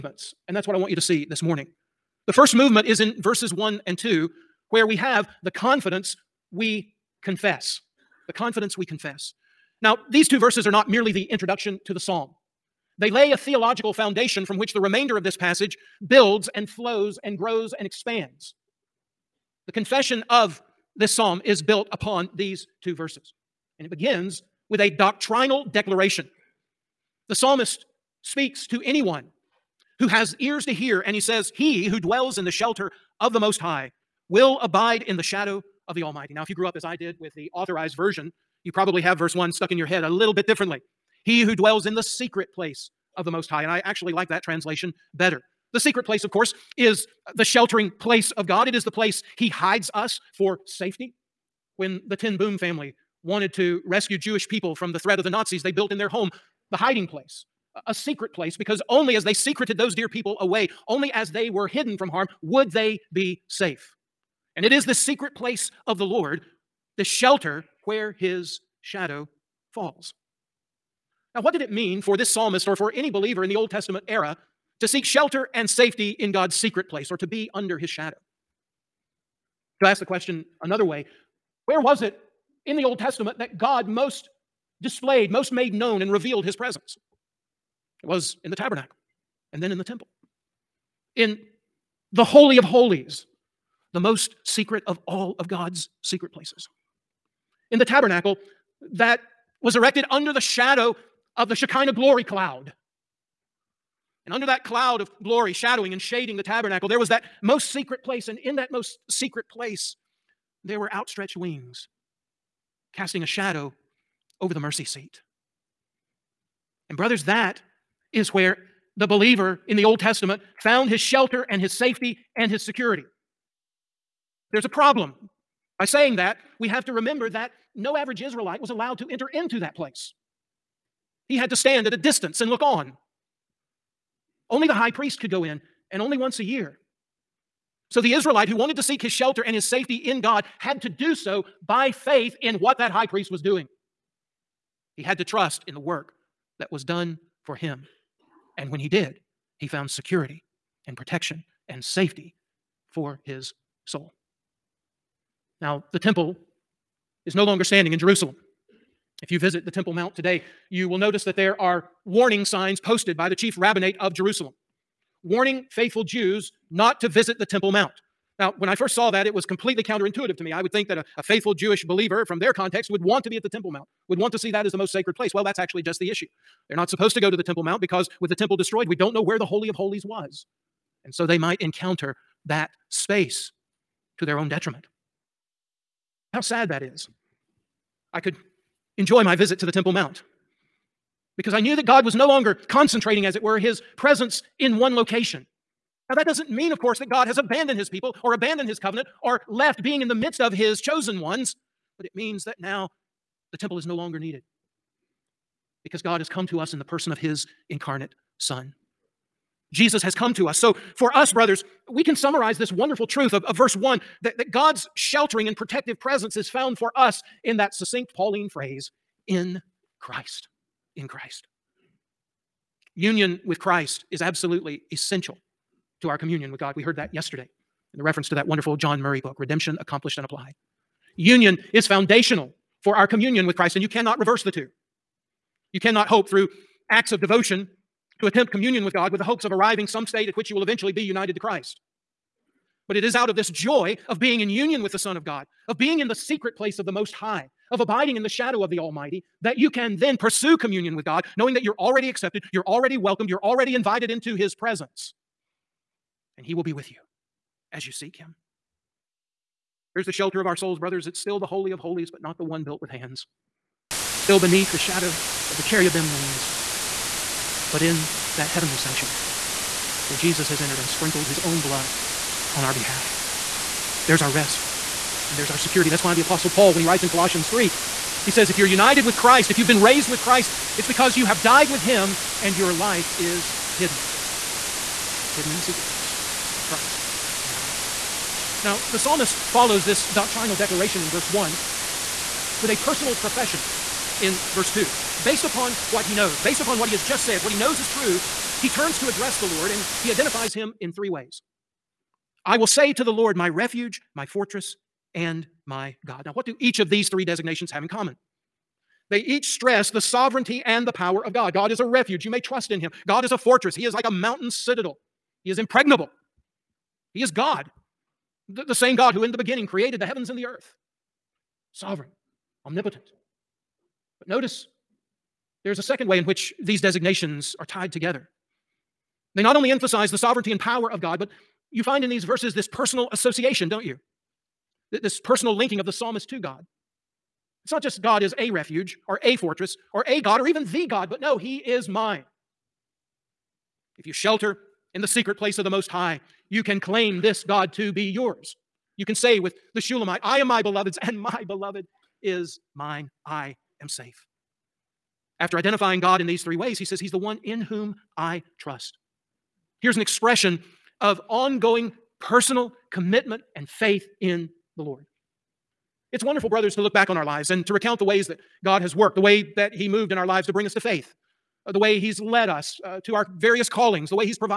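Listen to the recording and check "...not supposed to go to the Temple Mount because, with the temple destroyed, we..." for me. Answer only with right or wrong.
right.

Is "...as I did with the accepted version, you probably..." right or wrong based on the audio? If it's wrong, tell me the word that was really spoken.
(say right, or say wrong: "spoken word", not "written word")
wrong: "authorized", not "accepted".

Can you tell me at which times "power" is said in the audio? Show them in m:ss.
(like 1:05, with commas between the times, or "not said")
5:10, 5:30.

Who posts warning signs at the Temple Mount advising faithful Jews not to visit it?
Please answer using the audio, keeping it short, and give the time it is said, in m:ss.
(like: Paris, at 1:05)
chief rabbinate of Jerusalem, at 2:43.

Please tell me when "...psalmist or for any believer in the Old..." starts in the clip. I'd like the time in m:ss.
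1:12.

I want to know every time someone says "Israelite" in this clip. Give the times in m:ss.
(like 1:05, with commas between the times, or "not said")
2:08, 2:18.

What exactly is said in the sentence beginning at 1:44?
And under that cloud of glory, shadowing and shading the tabernacle, there was that most secret place.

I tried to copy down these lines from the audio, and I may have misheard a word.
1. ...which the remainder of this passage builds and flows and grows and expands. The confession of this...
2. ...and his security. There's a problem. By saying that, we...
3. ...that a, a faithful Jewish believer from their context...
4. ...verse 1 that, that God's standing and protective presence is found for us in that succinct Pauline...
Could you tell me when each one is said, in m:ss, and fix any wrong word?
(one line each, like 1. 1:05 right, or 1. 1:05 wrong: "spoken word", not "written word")
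1. 0:14 right
2. 2:02 right
3. 2:50 right
4. 3:33 wrong: "sheltering", not "standing".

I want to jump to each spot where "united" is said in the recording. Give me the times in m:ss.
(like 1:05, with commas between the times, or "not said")
4:01, 4:38.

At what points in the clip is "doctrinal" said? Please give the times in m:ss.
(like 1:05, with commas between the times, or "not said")
0:24, 4:50.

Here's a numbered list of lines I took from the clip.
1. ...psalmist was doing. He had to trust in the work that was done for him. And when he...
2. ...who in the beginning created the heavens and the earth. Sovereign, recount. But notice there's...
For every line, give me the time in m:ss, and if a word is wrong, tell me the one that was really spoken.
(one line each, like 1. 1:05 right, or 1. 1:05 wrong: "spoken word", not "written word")
1. 2:23 wrong: "priest", not "psalmist"
2. 5:19 wrong: "omnipotent", not "recount".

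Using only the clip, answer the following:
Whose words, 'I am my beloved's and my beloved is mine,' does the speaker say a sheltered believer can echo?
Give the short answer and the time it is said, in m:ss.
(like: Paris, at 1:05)
the Shulamite, at 5:49.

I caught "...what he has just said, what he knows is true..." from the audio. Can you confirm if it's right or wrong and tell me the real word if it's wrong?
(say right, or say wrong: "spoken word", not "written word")
right.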